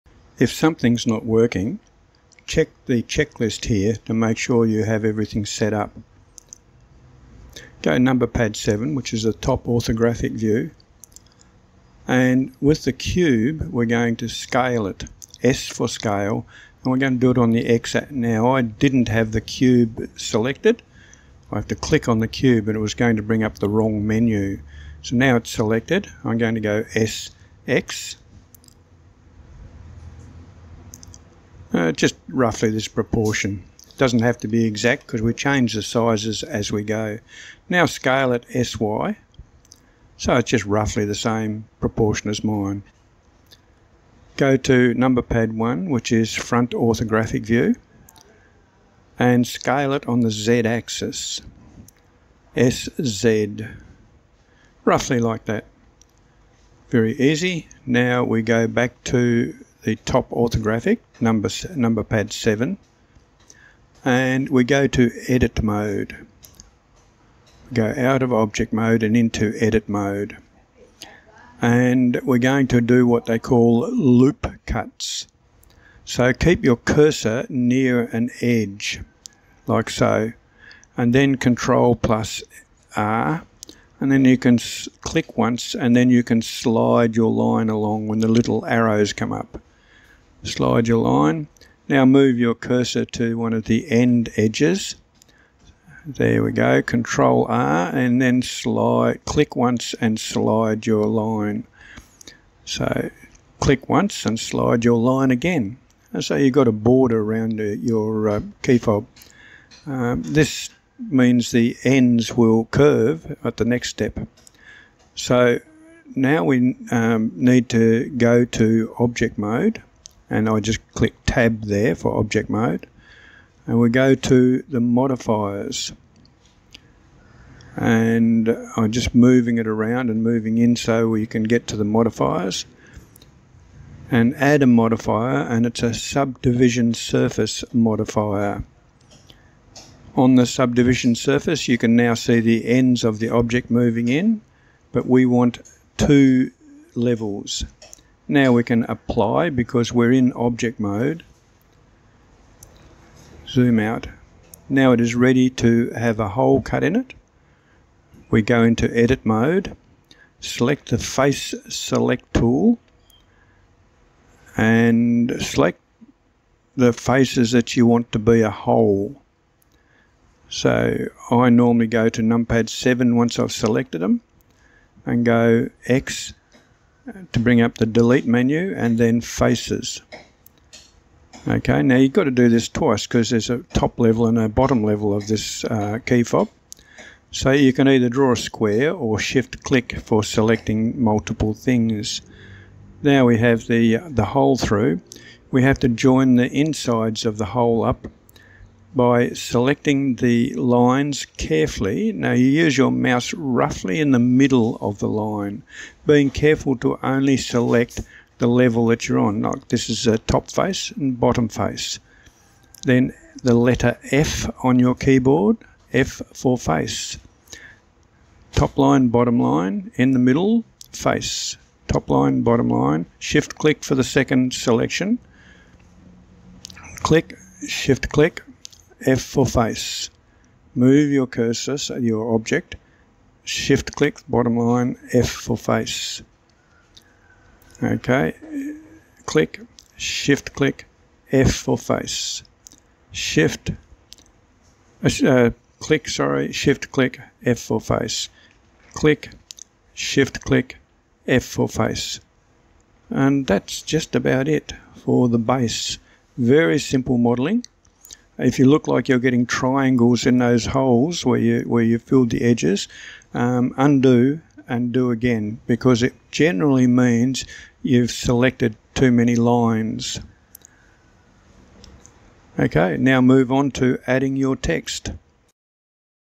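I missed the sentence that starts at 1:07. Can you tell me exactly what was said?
Go out of object mode and into edit mode.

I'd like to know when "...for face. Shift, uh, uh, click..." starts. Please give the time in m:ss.
4:01.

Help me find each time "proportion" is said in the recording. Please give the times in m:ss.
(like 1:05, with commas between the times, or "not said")
0:32, 0:41.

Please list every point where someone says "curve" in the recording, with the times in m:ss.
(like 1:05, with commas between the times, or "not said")
1:52.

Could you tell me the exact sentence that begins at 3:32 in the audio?
Then the letter F on your keyboard, F for face.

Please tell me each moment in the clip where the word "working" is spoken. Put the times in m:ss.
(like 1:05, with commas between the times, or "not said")
0:01.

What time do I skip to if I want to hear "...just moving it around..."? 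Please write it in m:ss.
2:08.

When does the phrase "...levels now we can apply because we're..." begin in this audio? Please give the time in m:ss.
2:26.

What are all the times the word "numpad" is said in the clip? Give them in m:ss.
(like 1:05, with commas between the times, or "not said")
2:52.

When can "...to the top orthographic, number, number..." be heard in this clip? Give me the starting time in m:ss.
0:59.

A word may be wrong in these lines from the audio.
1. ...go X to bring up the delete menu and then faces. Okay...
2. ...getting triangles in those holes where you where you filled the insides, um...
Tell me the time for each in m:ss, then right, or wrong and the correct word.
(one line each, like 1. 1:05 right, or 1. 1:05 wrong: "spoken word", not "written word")
1. 2:55 right
2. 4:19 wrong: "edges", not "insides".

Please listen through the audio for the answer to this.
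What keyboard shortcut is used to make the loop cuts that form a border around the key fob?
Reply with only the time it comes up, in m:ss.
1:21.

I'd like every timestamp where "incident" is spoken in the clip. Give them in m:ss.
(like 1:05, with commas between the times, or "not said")
not said.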